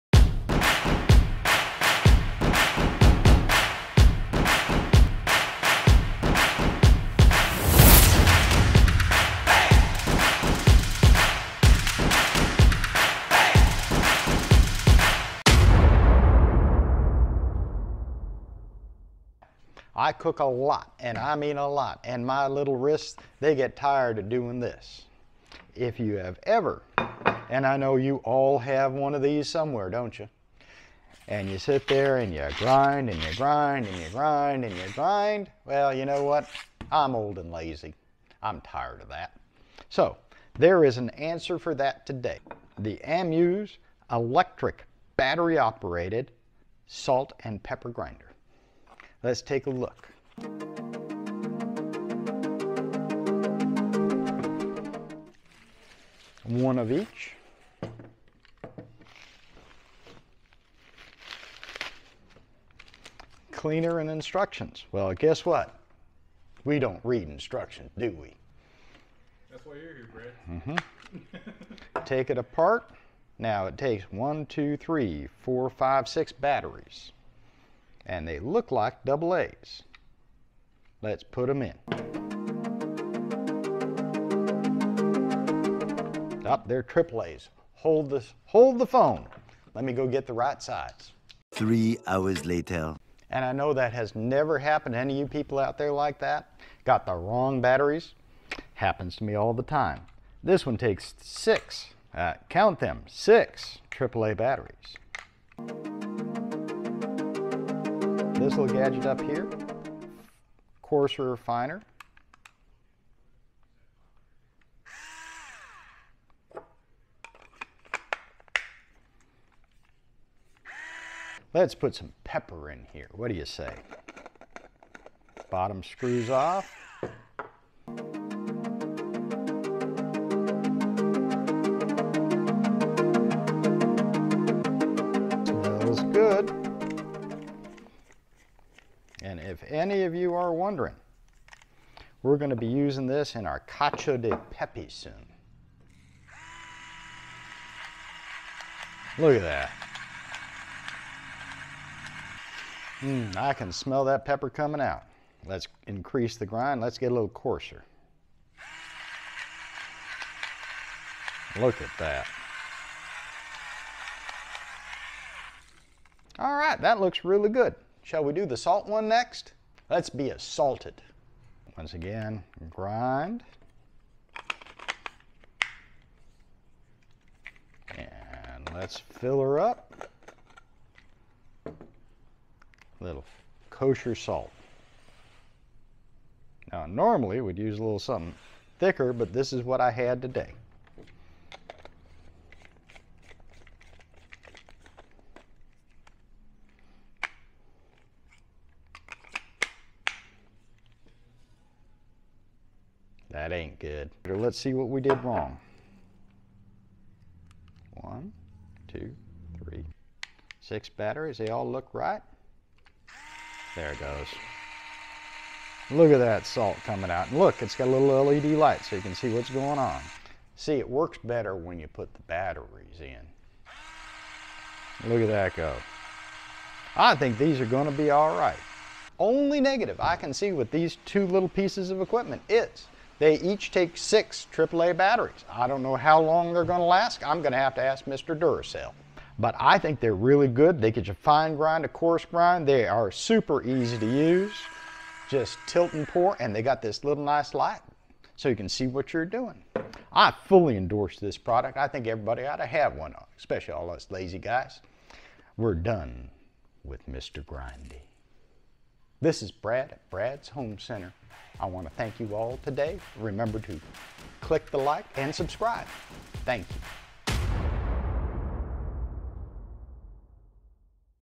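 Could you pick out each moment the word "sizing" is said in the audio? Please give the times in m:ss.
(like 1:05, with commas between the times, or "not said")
not said.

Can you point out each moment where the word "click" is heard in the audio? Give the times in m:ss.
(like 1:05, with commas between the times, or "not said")
4:24.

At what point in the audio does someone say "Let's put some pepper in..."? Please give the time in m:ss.
2:01.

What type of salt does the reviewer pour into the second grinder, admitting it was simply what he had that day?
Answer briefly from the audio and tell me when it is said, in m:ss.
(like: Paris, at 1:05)
Kosher salt, at 3:03.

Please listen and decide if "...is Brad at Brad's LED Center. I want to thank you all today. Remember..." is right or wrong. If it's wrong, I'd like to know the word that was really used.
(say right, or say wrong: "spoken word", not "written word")
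wrong: "Home", not "LED".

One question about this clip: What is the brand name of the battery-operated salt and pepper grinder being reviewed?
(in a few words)
Amuse.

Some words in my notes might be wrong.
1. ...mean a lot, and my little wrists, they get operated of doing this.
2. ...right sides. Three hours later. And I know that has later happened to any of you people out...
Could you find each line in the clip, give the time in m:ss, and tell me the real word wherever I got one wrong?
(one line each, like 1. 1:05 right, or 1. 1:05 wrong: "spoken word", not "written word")
1. 0:21 wrong: "tired", not "operated"
2. 1:30 wrong: "never", not "later".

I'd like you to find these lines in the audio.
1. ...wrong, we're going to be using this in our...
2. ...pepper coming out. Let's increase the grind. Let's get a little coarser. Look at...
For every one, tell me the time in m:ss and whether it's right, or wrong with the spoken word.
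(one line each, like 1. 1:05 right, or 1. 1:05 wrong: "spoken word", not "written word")
1. 2:20 wrong: "wondering", not "wrong"
2. 2:34 right.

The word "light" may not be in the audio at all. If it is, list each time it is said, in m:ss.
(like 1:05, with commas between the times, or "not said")
3:38, 4:07.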